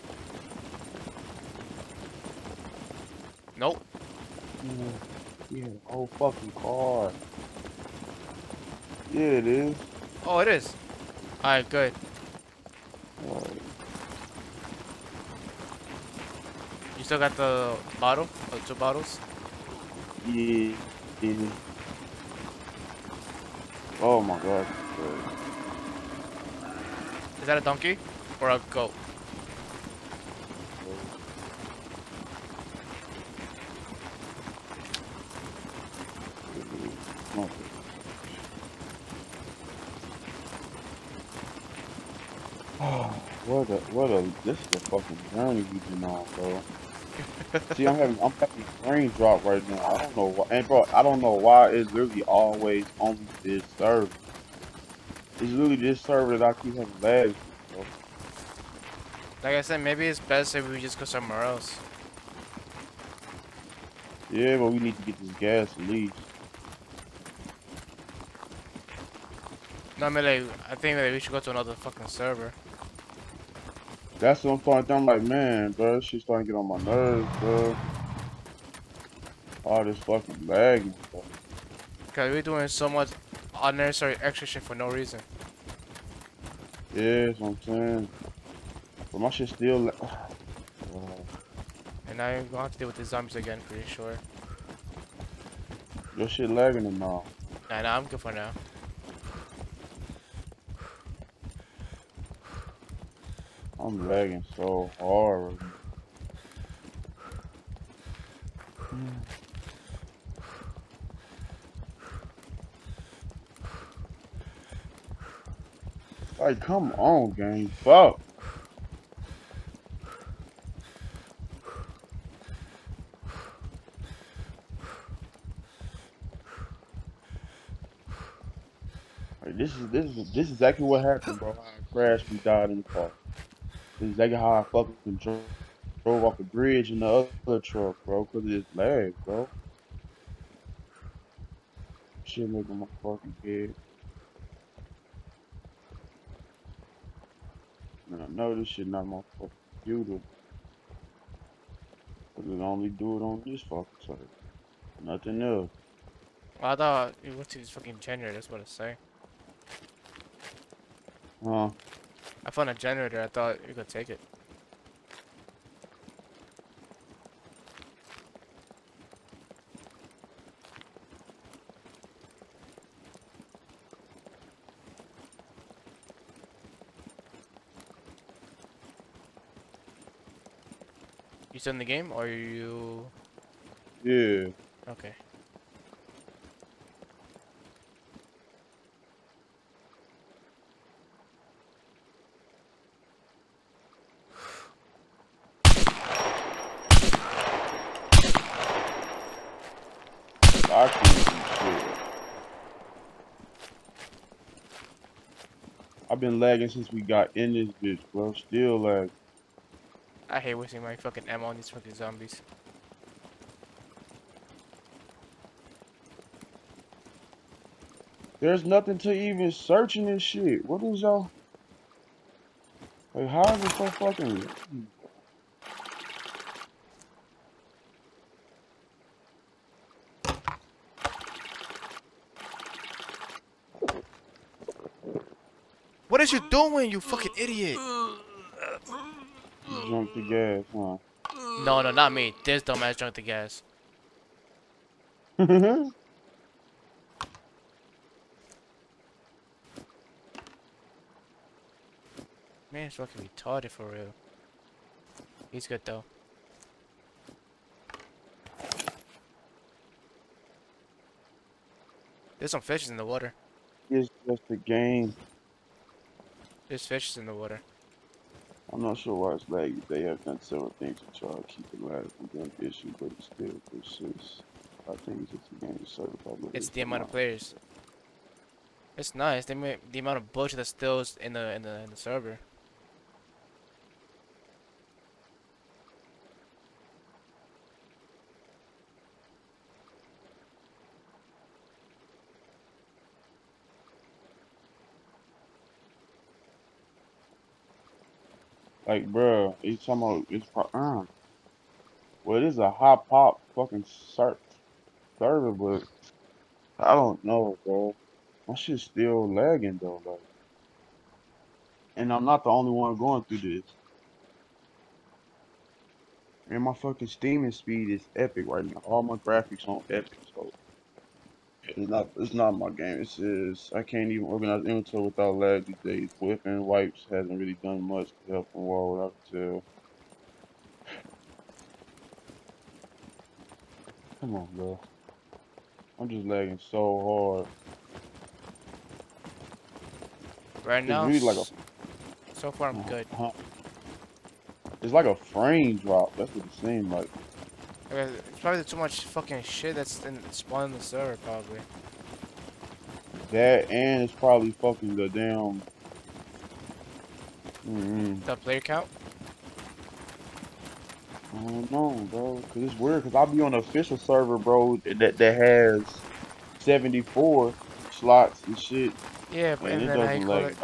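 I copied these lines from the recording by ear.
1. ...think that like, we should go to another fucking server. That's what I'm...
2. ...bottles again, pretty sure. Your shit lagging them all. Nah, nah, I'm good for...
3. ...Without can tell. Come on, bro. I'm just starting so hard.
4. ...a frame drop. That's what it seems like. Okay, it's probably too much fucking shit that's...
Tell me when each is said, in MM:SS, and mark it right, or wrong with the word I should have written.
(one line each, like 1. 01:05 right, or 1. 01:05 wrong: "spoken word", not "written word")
1. 01:10 right
2. 01:33 wrong: "zombies", not "bottles"
3. 05:28 wrong: "lagging", not "starting"
4. 05:45 right.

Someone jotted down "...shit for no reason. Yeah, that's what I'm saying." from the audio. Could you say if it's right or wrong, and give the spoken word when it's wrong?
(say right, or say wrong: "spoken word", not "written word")
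right.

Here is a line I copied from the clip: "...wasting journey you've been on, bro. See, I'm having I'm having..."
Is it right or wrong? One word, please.
wrong.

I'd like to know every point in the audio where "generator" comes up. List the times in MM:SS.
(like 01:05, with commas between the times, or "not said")
02:37, 02:42.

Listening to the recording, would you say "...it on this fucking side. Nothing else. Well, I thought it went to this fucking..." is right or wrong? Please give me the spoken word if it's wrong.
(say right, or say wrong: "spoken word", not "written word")
right.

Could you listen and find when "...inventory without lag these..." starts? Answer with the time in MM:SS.
05:24.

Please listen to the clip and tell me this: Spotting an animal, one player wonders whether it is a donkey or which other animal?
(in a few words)
Goat.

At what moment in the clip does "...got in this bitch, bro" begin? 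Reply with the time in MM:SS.
03:27.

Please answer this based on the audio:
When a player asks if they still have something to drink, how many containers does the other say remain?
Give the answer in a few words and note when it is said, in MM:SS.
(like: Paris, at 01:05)
2, at 00:18.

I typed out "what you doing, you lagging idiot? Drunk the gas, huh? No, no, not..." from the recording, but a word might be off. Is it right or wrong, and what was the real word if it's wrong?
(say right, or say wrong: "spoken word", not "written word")
wrong: "fucking", not "lagging".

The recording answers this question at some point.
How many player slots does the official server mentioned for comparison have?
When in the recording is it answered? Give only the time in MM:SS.
06:06.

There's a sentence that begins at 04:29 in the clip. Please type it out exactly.
They have done several things to try to keep it alive from them issue, but it still persists.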